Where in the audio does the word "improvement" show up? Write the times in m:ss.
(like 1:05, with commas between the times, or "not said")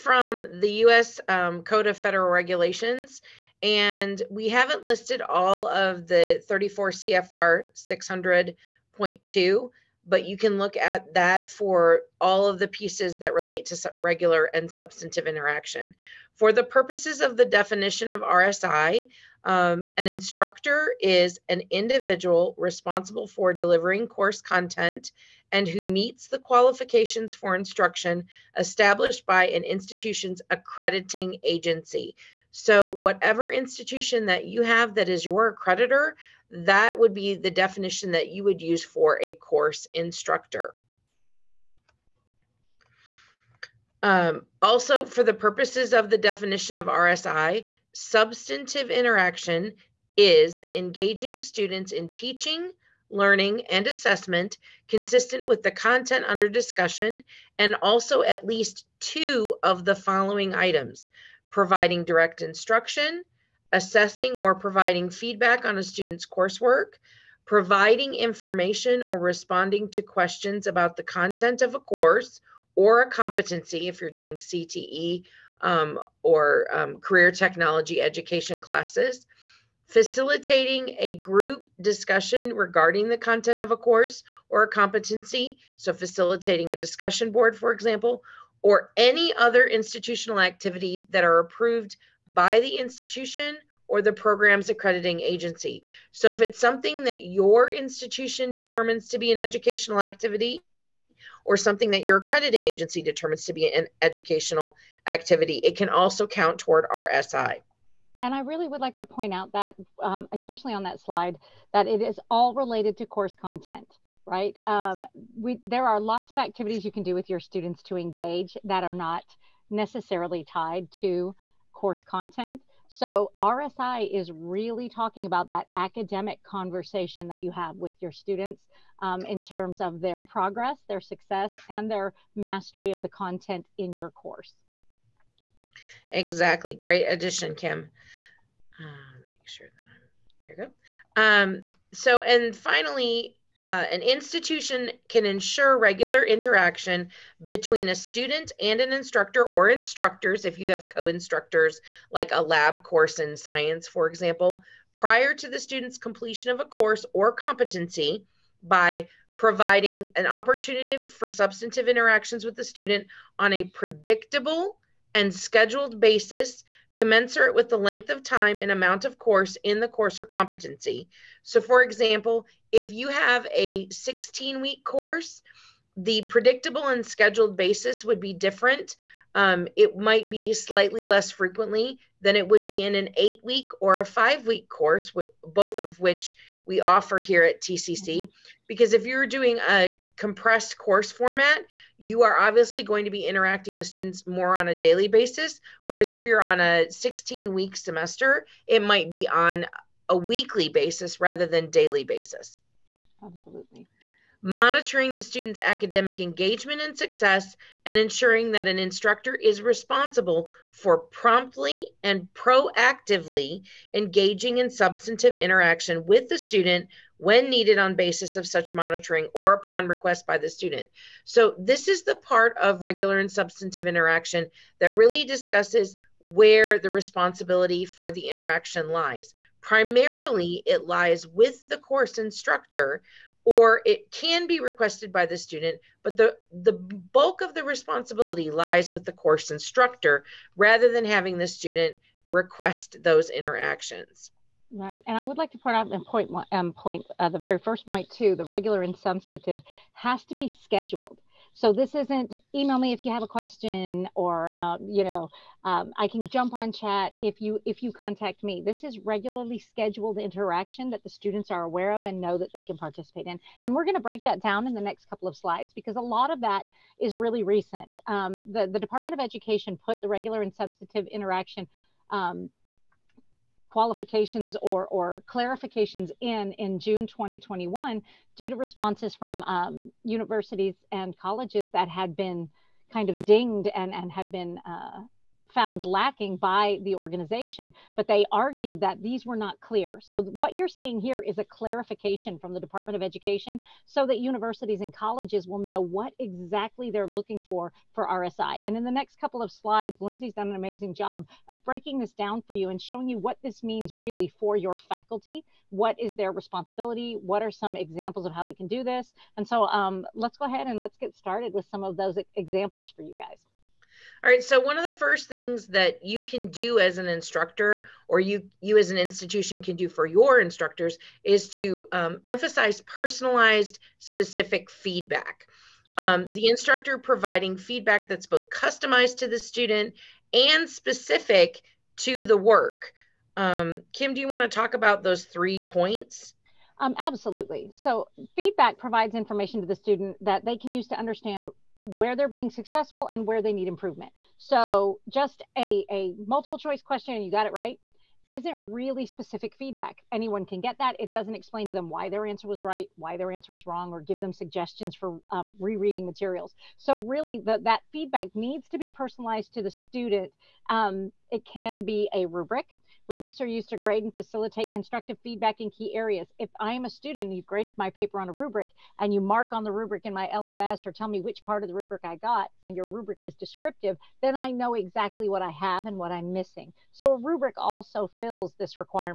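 5:43.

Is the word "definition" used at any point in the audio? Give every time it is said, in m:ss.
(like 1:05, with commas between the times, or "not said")
0:17, 0:37, 0:46.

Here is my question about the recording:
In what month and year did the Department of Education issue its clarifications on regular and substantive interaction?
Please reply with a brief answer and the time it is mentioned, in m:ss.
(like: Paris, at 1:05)
June 2021, at 4:36.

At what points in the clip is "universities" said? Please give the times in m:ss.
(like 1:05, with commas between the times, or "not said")
4:40, 4:54.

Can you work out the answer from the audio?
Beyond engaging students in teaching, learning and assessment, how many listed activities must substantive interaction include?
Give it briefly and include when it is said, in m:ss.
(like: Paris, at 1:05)
2, at 0:58.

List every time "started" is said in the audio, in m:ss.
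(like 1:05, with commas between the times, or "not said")
5:11.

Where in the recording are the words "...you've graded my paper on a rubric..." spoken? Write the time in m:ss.
6:07.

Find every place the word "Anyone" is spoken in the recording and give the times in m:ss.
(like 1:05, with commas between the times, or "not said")
5:50.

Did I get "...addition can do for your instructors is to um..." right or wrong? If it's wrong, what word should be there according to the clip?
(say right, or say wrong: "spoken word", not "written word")
wrong: "institution", not "addition".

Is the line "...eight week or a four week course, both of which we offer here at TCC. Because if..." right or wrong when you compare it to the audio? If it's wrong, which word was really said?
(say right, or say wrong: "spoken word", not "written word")
wrong: "five", not "four".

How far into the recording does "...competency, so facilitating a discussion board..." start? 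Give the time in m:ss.
1:24.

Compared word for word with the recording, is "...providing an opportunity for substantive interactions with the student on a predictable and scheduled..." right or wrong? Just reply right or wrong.
right.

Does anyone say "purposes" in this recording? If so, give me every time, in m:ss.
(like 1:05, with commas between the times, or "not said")
0:16, 0:45.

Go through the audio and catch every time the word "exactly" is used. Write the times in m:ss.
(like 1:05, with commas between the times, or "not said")
2:16, 4:56, 6:14.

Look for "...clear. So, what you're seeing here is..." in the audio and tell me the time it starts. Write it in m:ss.
4:49.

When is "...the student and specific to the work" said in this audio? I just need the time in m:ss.
5:29.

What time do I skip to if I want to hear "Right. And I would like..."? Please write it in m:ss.
4:04.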